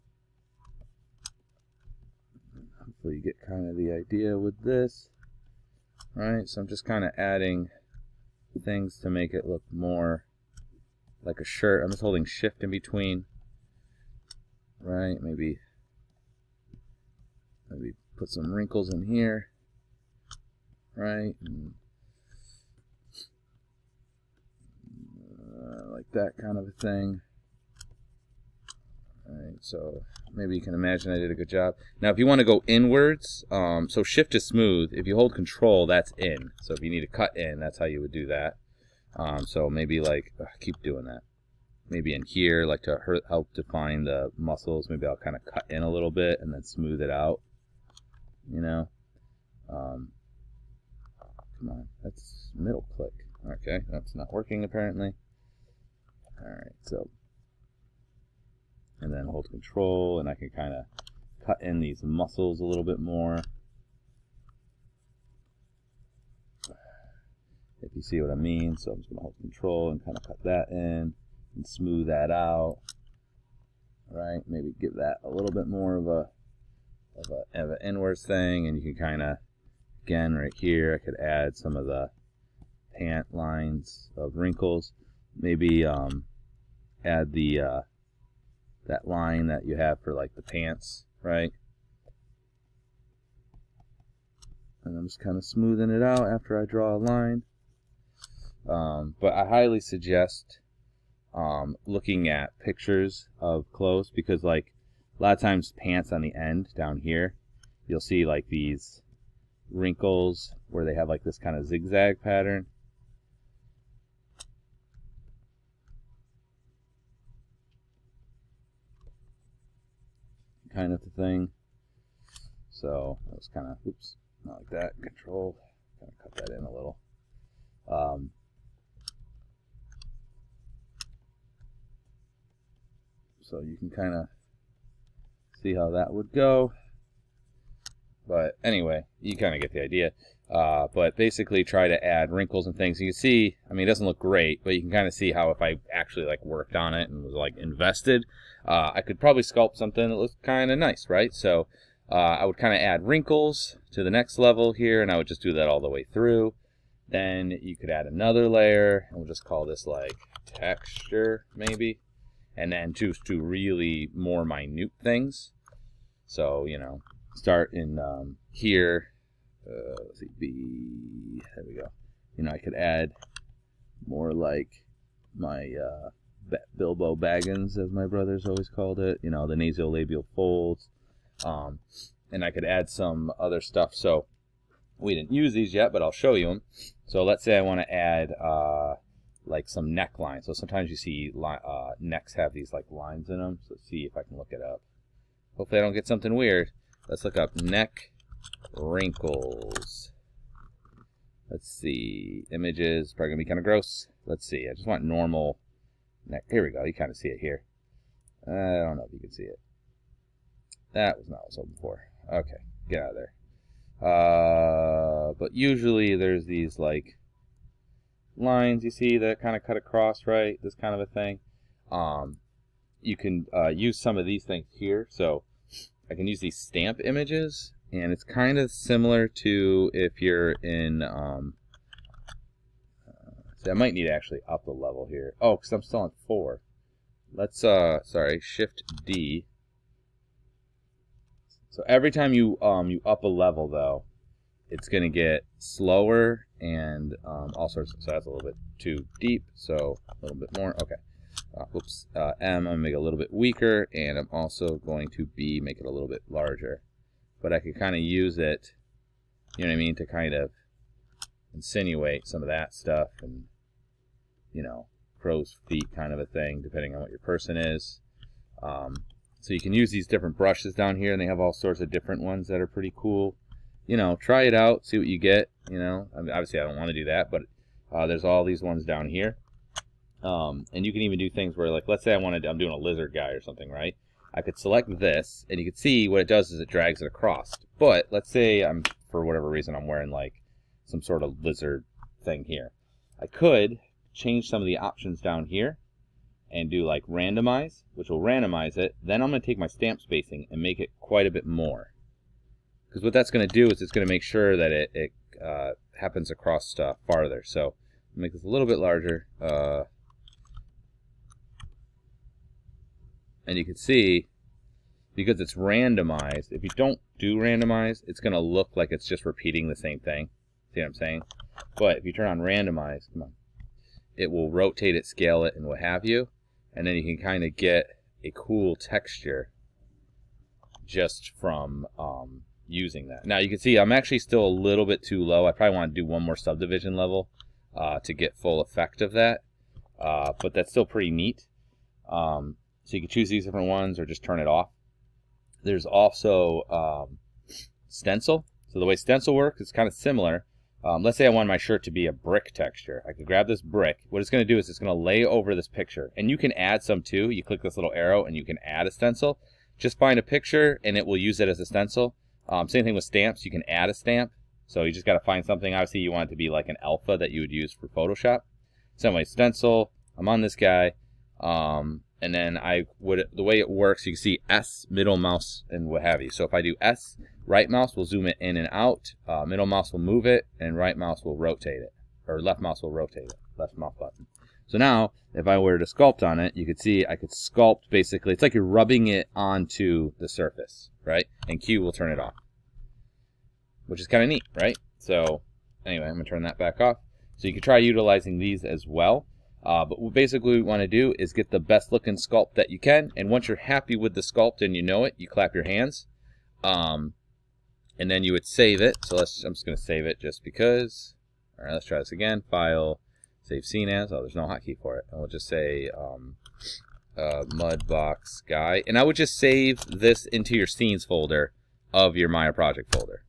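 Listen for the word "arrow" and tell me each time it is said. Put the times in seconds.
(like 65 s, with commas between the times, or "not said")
357 s.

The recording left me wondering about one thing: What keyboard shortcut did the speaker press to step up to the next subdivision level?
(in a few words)
Shift D.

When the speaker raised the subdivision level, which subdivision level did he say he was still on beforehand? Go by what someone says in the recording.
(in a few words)
4.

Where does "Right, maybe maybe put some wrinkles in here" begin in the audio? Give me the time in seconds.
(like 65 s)
14 s.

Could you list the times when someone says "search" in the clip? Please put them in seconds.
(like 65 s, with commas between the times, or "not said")
not said.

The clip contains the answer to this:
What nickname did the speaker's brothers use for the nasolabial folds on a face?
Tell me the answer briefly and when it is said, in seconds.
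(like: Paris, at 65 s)
Bilbo Baggins, at 176 s.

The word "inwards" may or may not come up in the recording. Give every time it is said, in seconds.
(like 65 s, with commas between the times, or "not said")
32 s, 77 s.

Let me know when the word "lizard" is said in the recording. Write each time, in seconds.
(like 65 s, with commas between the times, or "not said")
282 s, 291 s.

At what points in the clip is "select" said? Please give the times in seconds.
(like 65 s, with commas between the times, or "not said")
284 s.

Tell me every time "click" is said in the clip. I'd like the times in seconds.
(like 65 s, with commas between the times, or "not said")
52 s, 357 s.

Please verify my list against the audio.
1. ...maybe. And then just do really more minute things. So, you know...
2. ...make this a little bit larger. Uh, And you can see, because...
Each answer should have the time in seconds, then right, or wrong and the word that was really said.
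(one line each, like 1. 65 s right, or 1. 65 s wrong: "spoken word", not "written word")
1. 161 s right
2. 308 s right.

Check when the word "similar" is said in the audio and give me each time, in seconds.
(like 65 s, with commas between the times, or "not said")
228 s, 349 s.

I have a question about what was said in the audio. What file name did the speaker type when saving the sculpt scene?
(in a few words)
Mudbox guy.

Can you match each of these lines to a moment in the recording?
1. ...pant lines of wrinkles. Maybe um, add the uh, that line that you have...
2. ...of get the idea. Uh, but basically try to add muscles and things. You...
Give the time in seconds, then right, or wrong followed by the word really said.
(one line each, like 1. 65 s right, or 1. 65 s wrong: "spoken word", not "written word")
1. 82 s right
2. 139 s wrong: "wrinkles", not "muscles".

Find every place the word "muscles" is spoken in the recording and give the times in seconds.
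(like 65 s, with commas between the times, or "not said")
44 s, 62 s.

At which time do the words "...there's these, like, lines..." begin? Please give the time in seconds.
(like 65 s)
216 s.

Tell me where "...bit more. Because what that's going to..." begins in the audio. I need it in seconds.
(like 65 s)
301 s.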